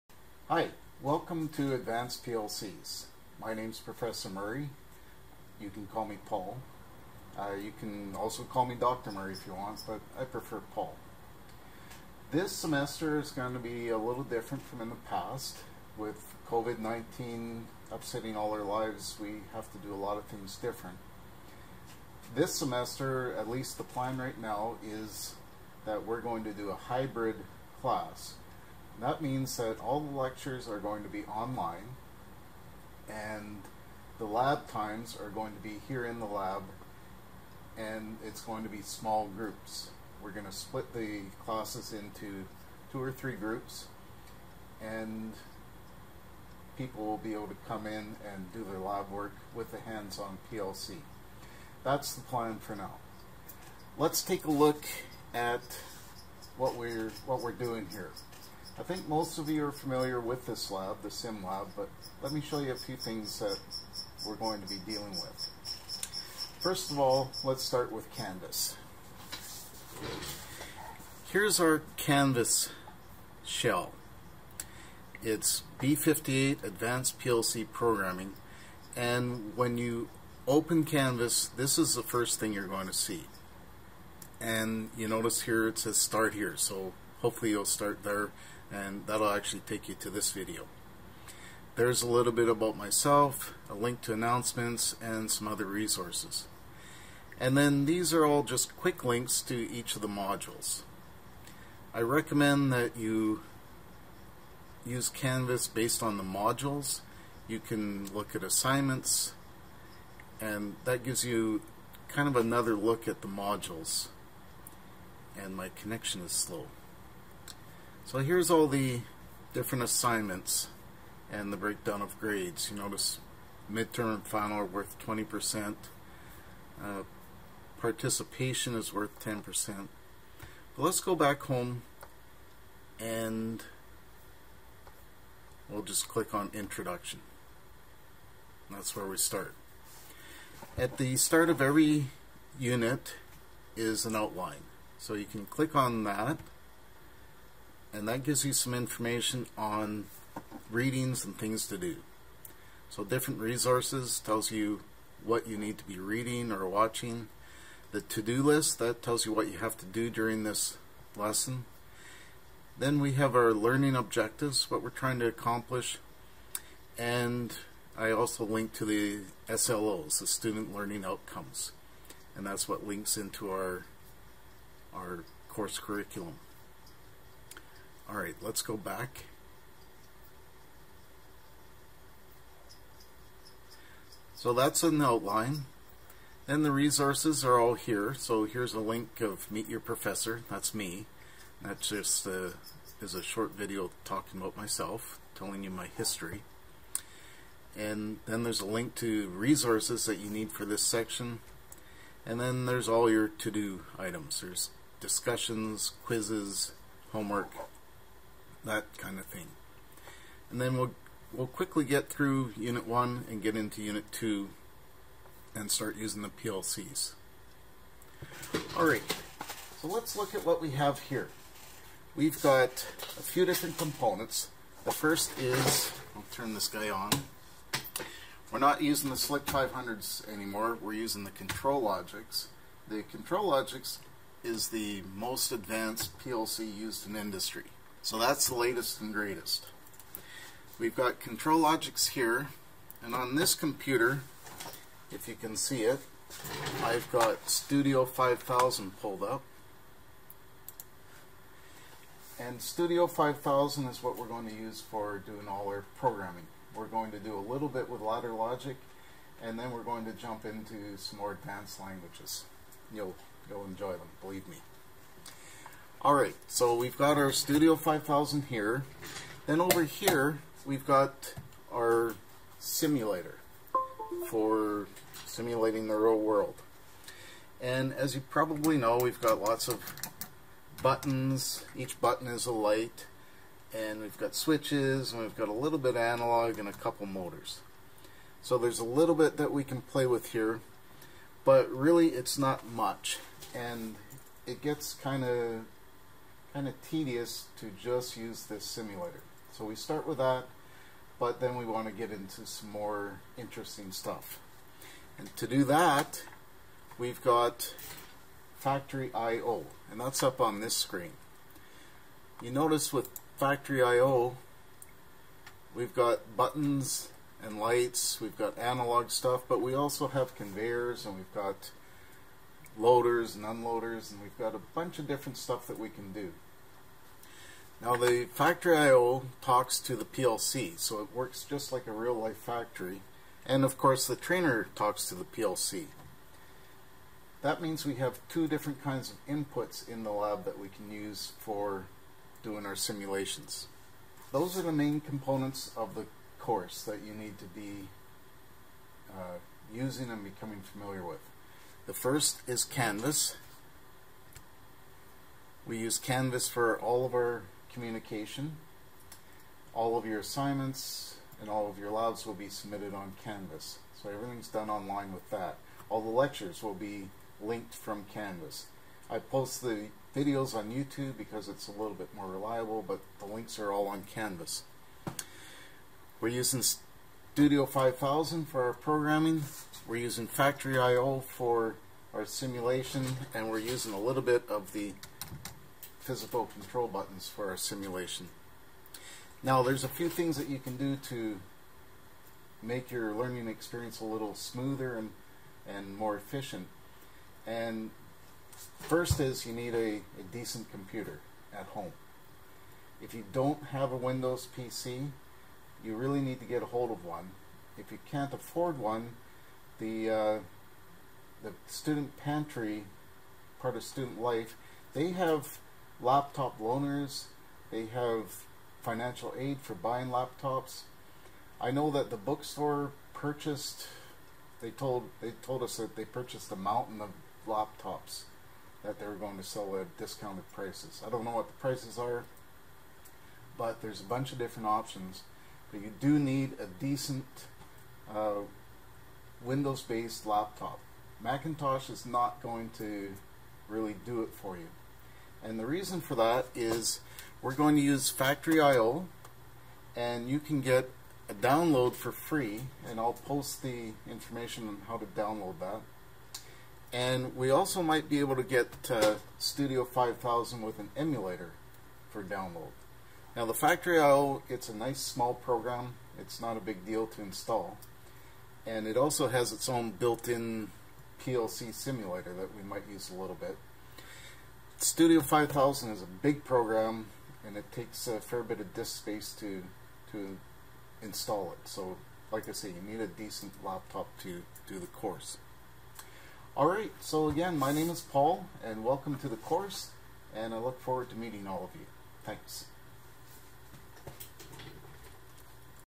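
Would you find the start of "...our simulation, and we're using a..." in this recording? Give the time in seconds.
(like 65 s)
382 s.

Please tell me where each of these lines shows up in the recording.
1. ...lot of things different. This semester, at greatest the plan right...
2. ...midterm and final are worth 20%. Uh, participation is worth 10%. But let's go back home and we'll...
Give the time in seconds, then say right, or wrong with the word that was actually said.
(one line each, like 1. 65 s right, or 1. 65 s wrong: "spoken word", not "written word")
1. 19 s wrong: "least", not "greatest"
2. 123 s right.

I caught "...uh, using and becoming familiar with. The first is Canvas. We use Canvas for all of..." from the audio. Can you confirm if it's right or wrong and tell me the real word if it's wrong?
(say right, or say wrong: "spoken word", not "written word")
right.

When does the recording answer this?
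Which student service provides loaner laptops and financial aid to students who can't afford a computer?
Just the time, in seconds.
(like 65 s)
411 s.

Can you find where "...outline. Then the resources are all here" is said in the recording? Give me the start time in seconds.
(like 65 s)
185 s.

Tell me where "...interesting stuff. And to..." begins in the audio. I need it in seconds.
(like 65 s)
303 s.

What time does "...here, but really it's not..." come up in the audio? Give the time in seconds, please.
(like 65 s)
290 s.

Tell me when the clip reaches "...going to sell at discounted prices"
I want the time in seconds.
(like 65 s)
429 s.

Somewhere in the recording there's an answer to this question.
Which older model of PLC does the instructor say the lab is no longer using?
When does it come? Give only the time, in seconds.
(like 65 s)
229 s.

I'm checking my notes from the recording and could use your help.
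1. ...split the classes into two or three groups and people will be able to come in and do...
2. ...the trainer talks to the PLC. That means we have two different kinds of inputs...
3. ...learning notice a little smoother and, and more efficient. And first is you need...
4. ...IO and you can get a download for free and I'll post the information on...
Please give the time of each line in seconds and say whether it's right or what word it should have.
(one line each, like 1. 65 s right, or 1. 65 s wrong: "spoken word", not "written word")
1. 40 s right
2. 334 s right
3. 393 s wrong: "experience", not "notice"
4. 448 s right.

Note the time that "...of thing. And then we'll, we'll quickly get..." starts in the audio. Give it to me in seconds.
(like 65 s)
209 s.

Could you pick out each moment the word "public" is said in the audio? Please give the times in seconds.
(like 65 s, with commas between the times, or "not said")
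not said.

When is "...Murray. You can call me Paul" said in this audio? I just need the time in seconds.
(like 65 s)
4 s.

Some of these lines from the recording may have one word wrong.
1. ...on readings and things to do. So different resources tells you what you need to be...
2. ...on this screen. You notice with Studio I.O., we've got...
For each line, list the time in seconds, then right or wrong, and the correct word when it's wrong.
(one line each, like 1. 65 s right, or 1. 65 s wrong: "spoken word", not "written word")
1. 149 s right
2. 310 s wrong: "Factory", not "Studio".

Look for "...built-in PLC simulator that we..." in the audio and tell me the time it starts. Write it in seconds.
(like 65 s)
469 s.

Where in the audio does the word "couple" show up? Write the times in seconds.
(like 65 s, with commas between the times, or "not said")
286 s.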